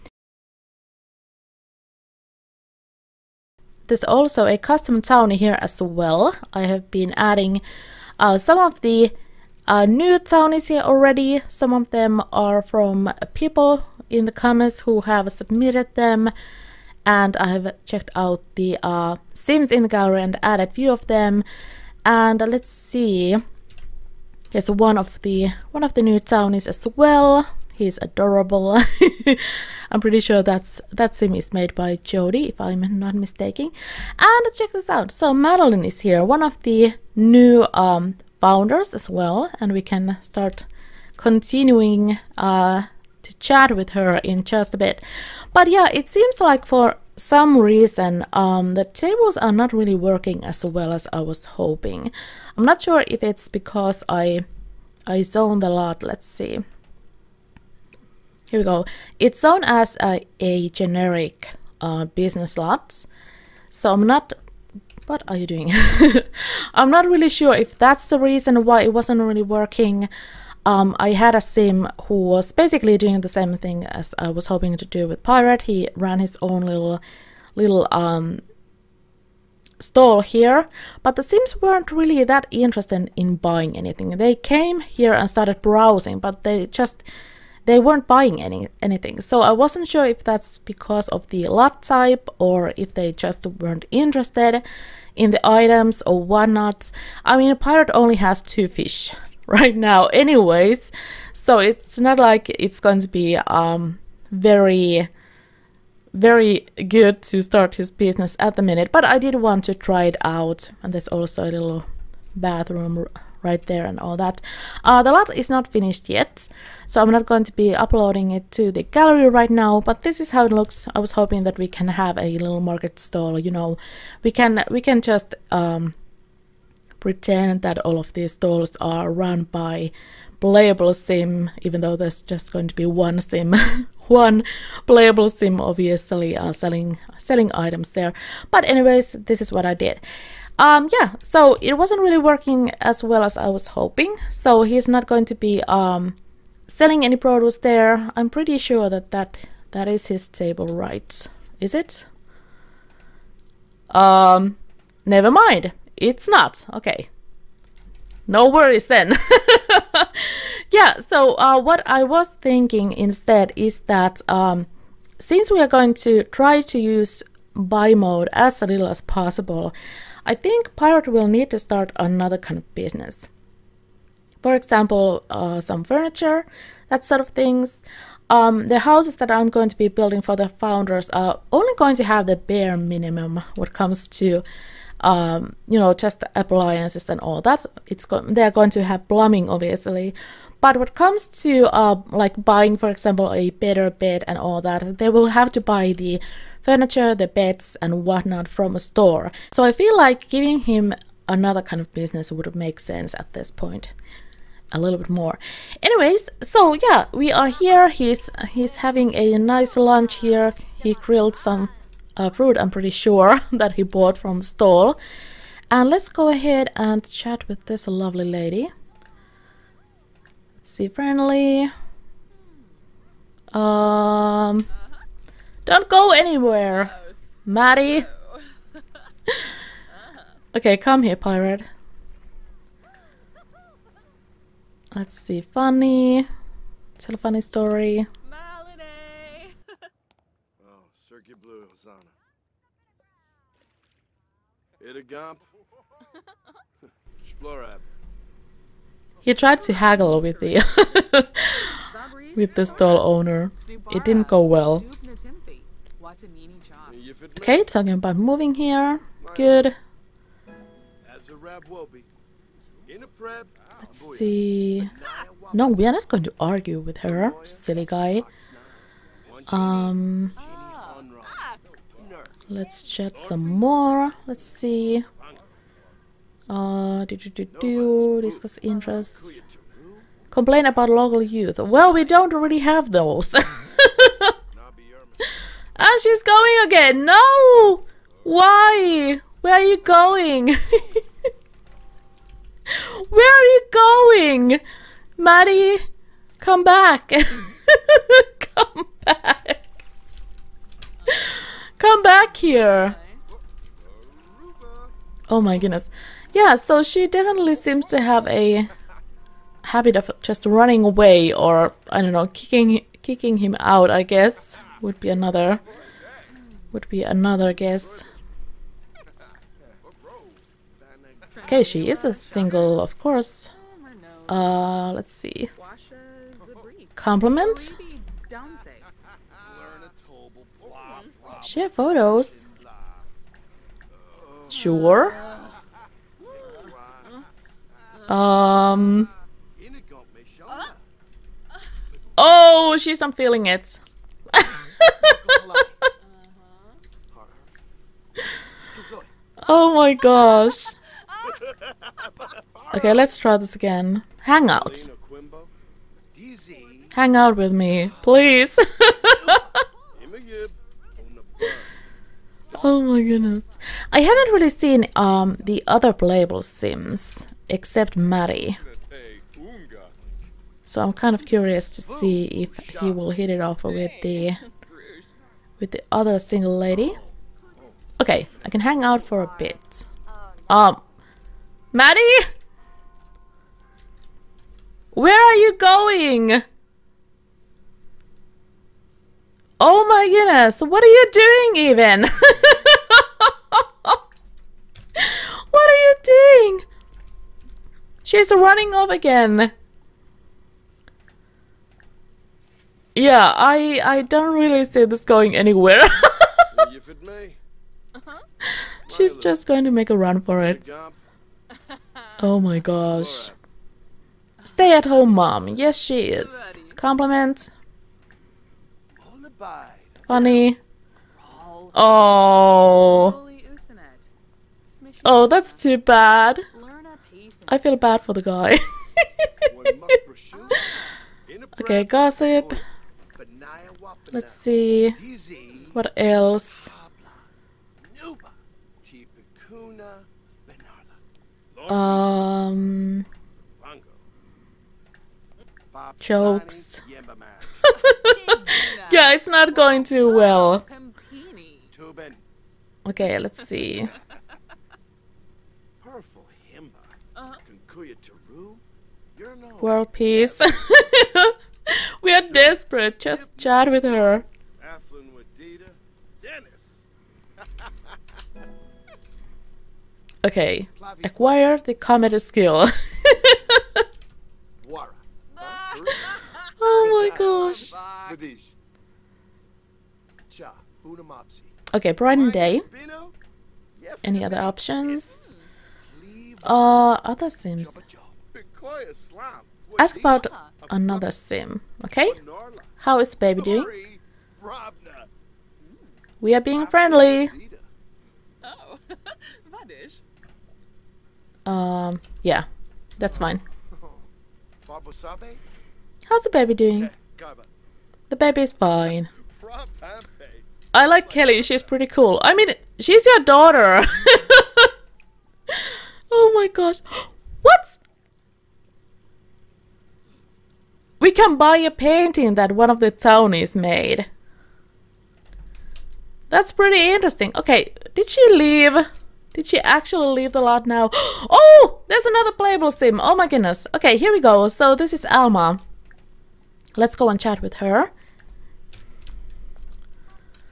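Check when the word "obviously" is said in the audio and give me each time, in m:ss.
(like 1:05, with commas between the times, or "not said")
2:15, 3:09.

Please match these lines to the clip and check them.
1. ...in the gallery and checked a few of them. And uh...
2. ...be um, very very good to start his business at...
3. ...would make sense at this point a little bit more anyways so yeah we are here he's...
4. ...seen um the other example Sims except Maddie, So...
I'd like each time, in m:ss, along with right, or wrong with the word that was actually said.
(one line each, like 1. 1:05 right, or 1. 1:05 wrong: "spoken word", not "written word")
1. 0:19 wrong: "added", not "checked"
2. 1:43 right
3. 3:22 right
4. 6:04 wrong: "playable", not "example".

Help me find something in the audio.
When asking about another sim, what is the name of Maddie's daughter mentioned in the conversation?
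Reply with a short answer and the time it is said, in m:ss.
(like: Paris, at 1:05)
Kelly, at 8:31.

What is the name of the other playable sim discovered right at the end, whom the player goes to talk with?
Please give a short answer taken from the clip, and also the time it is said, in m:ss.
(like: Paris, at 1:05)
Alma, at 8:55.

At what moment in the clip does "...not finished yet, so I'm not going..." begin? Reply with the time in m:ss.
1:55.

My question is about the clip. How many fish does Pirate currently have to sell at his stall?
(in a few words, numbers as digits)
2.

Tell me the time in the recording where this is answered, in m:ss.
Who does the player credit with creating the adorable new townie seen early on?
0:32.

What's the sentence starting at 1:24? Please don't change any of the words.
They came here and started browsing, but they just they weren't buying any anything.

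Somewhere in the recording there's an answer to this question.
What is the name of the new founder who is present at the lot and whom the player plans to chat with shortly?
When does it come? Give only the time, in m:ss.
0:35.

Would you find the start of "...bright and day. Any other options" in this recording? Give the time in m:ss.
8:01.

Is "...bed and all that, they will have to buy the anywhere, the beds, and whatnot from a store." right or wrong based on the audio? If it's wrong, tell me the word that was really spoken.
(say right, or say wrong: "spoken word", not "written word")
wrong: "furniture", not "anywhere".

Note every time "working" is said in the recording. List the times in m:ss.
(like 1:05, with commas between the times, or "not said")
0:49, 1:09, 2:22.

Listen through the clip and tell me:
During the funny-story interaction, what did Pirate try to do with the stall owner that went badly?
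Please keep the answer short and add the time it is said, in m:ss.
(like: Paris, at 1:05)
Haggle, at 4:09.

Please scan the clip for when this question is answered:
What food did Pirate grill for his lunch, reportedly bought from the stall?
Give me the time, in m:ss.
3:32.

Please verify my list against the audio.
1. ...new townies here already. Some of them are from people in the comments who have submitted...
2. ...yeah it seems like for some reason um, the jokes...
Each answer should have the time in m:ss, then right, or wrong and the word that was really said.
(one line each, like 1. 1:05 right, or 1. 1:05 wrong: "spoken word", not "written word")
1. 0:09 right
2. 0:45 wrong: "tables", not "jokes".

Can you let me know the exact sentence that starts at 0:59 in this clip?
It's known as a, a generic uh, business lots.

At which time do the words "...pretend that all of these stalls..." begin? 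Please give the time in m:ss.
2:06.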